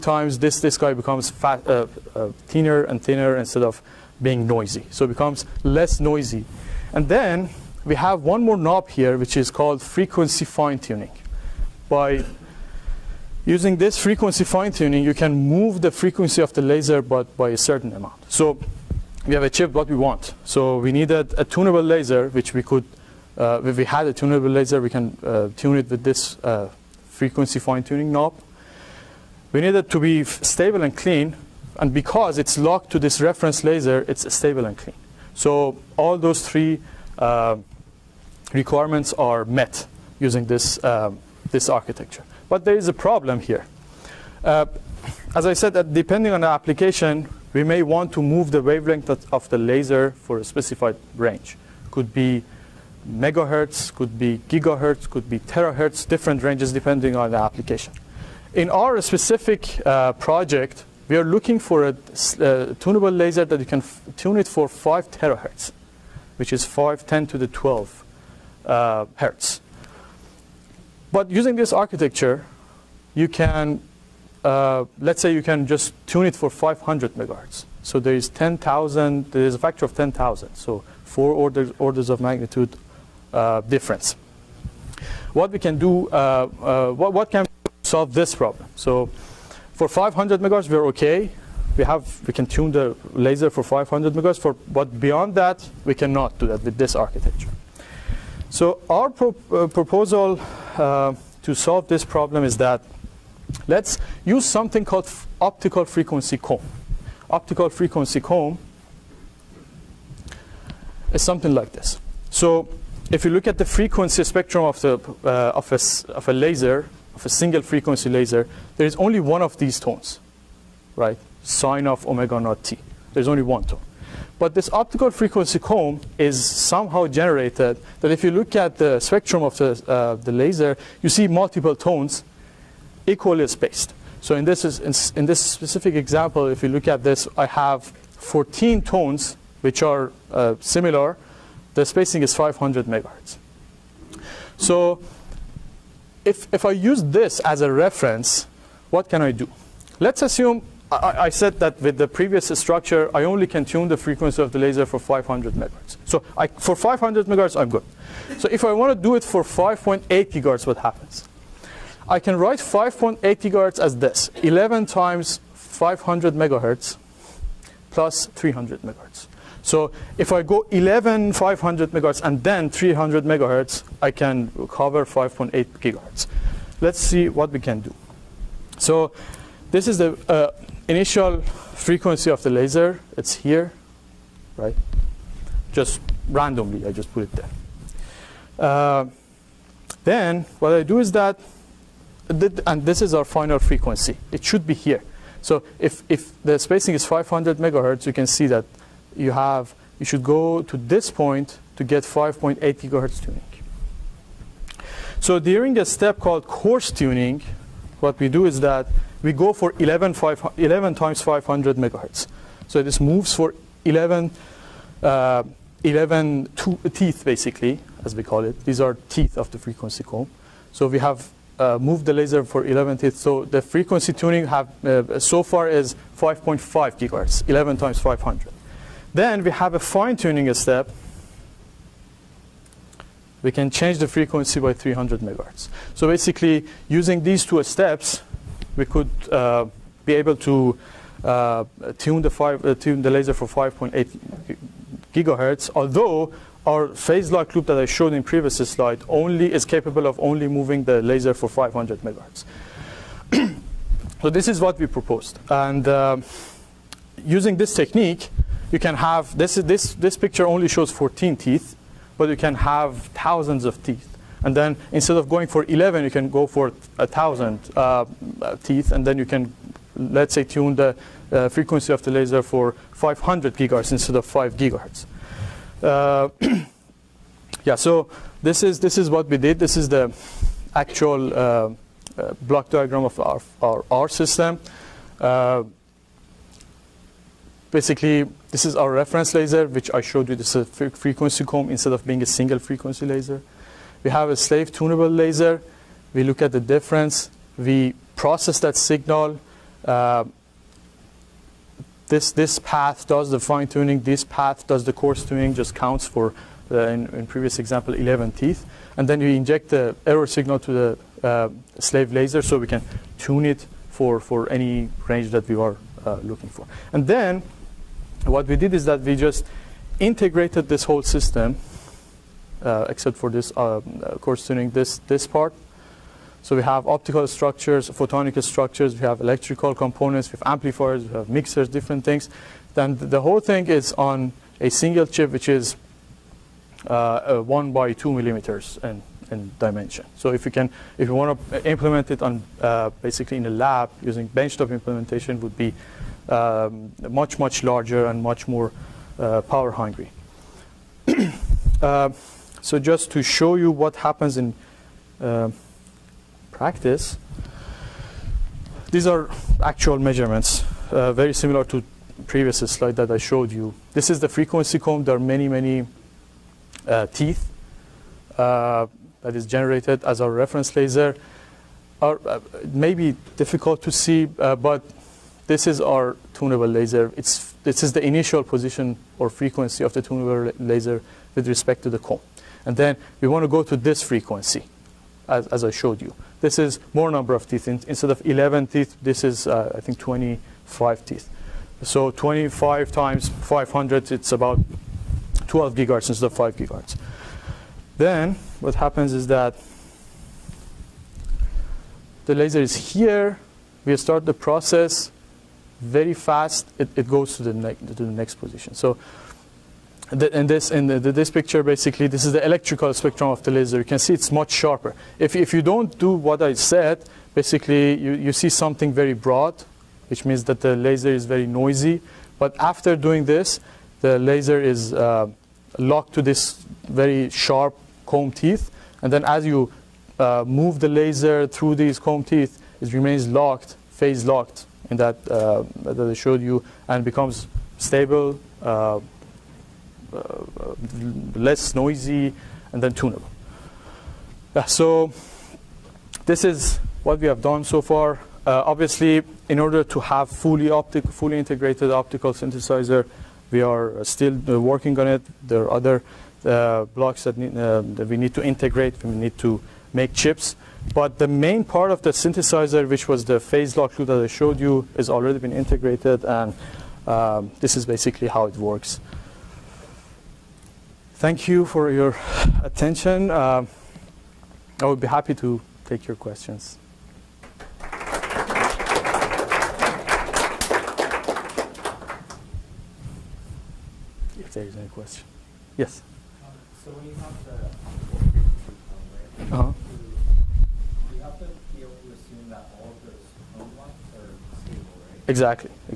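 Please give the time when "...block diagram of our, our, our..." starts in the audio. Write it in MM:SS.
04:42.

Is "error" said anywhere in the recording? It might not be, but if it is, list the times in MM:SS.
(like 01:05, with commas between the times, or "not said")
05:10.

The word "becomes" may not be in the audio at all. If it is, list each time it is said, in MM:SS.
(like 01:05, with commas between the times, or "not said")
00:00, 00:05, 07:17.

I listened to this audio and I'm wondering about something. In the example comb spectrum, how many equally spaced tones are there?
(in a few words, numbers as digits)
14.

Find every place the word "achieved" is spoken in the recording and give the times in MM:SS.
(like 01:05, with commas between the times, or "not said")
00:19.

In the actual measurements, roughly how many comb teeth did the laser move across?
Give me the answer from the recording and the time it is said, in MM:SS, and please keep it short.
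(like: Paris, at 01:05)
25, at 06:29.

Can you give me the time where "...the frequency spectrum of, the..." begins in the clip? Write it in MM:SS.
01:53.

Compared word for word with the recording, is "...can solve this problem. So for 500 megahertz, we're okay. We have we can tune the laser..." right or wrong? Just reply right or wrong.
right.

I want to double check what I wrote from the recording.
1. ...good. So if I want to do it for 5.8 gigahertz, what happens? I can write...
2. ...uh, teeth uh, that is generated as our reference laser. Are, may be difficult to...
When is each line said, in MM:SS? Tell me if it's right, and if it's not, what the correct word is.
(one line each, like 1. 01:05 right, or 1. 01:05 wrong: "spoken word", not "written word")
1. 02:37 right
2. 06:06 right.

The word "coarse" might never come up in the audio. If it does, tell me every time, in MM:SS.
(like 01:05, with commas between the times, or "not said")
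03:26, 05:04, 05:24.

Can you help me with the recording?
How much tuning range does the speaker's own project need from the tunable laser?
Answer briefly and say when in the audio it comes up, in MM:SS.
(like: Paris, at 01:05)
5 terahertz, at 01:04.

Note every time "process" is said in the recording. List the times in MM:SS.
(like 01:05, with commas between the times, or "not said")
04:58, 06:44.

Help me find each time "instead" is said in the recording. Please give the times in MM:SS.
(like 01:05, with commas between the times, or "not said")
00:03, 04:24, 04:33, 04:51, 06:27, 06:36.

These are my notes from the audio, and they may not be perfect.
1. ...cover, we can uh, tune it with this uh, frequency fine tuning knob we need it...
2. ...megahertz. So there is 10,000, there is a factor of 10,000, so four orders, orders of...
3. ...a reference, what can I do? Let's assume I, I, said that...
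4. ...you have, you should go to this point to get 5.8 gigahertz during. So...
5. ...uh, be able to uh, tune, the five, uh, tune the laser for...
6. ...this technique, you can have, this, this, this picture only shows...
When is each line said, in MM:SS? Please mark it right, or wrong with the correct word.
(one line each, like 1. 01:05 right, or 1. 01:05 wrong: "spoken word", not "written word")
1. 00:24 wrong: "laser", not "cover"
2. 01:17 right
3. 02:27 right
4. 03:19 wrong: "tuning", not "during"
5. 03:59 right
6. 04:17 right.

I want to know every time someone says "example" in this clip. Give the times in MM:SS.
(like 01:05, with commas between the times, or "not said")
02:15, 05:07.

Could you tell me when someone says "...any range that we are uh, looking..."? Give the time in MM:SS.
05:14.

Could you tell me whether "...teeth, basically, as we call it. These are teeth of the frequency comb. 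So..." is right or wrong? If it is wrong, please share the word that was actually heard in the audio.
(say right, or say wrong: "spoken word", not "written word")
right.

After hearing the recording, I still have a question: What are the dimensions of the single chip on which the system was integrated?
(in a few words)
1 by 2 millimeters.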